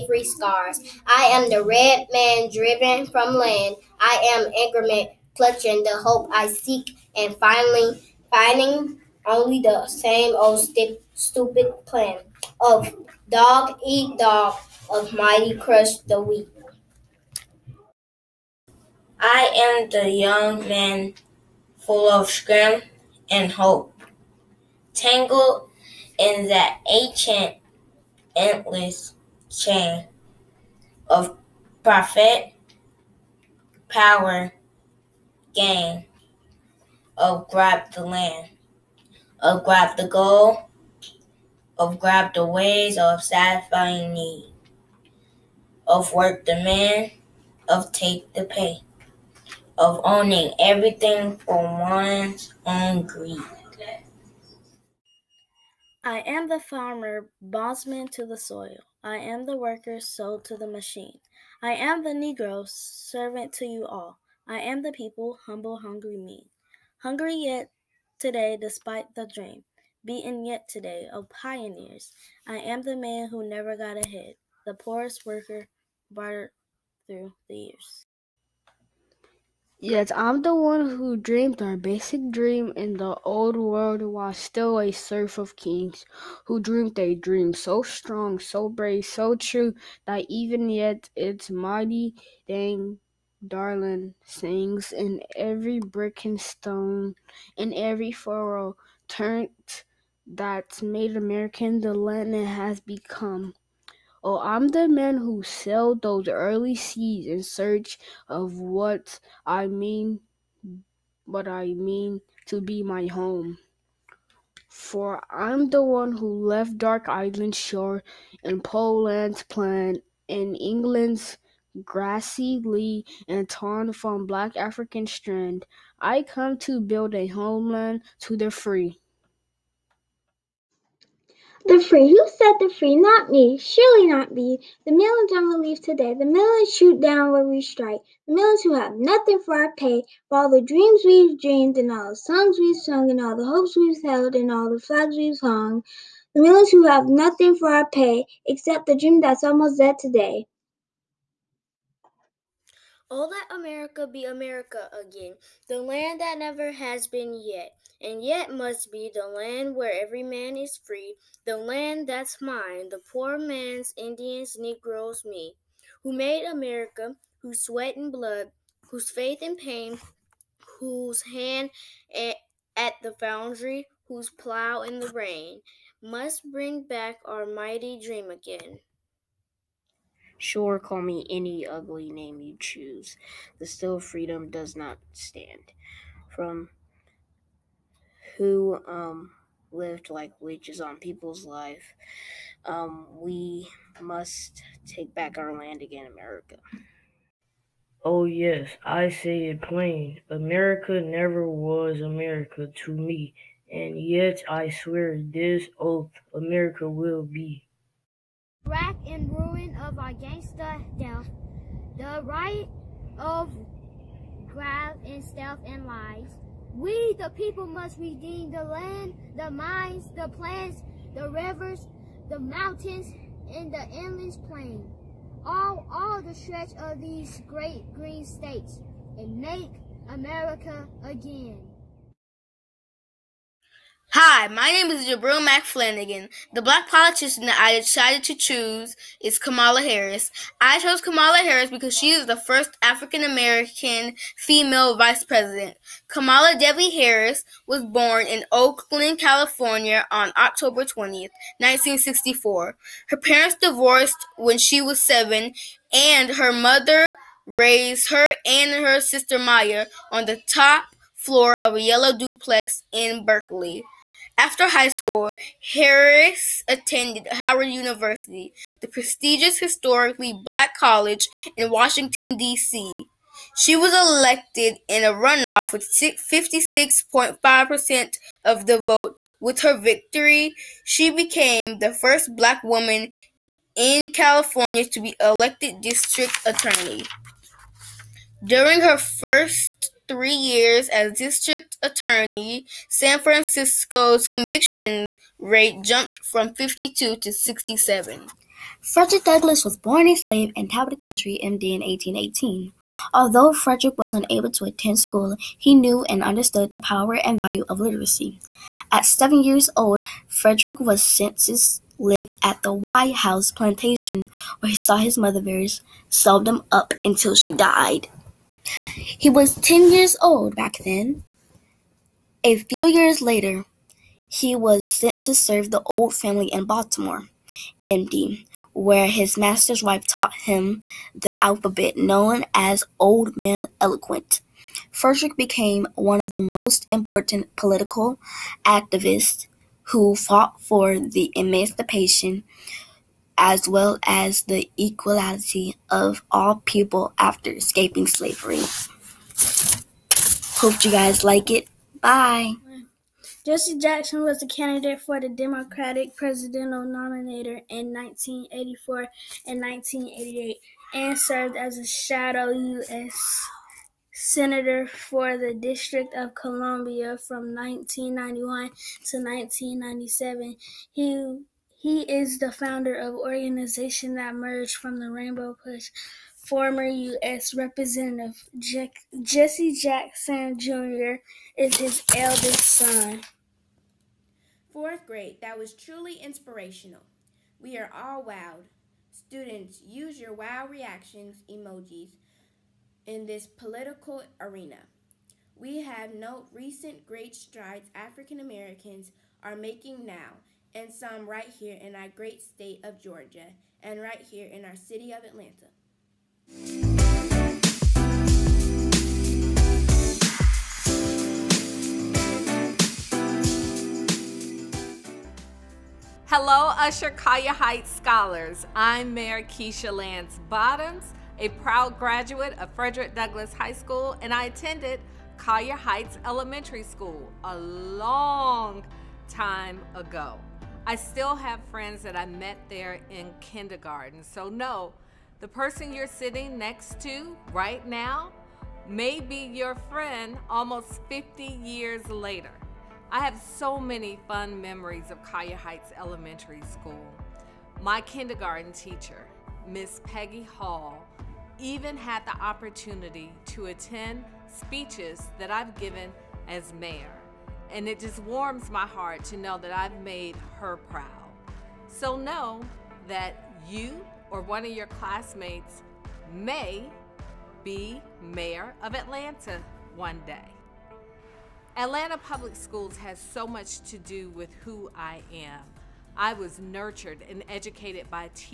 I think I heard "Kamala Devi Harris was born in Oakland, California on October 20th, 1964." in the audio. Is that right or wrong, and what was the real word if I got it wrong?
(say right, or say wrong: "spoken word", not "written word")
right.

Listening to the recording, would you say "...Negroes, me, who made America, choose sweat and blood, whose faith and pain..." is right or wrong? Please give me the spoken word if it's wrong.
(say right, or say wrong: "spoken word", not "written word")
wrong: "whose", not "choose".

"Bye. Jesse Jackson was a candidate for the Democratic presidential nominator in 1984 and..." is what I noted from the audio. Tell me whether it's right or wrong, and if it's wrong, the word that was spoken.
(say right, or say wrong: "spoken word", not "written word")
right.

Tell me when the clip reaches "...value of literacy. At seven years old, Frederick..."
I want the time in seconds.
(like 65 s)
307 s.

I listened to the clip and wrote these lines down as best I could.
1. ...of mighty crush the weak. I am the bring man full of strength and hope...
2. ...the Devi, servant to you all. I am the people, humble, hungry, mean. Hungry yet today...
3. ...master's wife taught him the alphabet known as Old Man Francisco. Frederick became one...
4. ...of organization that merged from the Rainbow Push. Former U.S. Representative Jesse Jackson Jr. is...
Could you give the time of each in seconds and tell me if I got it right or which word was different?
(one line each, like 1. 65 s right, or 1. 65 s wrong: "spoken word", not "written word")
1. 14 s wrong: "young", not "bring"
2. 62 s wrong: "Negro", not "Devi"
3. 329 s wrong: "Eloquent", not "Francisco"
4. 372 s right.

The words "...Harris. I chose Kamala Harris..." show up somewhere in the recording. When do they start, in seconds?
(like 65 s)
239 s.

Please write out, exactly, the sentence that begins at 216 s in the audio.
We, the people, must redeem the land, the mines, the plants, the rivers, the mountains, and the endless plain.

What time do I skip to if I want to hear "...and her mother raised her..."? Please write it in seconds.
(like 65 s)
255 s.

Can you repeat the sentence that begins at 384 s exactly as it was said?
Fourth grade, that was truly inspirational.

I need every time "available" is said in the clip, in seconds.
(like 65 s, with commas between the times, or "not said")
not said.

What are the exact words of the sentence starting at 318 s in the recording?
He was 10 years Auld back then.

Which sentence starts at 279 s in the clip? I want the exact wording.
With her victory, she became the first black woman in California to be elected district attorney.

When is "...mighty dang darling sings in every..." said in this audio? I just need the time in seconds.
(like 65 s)
91 s.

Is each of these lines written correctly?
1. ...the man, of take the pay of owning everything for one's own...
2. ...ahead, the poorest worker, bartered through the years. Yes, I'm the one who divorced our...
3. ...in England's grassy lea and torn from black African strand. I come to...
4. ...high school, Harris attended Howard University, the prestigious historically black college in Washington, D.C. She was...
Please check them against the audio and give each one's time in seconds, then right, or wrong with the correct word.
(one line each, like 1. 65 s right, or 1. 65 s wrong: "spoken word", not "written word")
1. 46 s right
2. 74 s wrong: "dreamed", not "divorced"
3. 120 s right
4. 264 s right.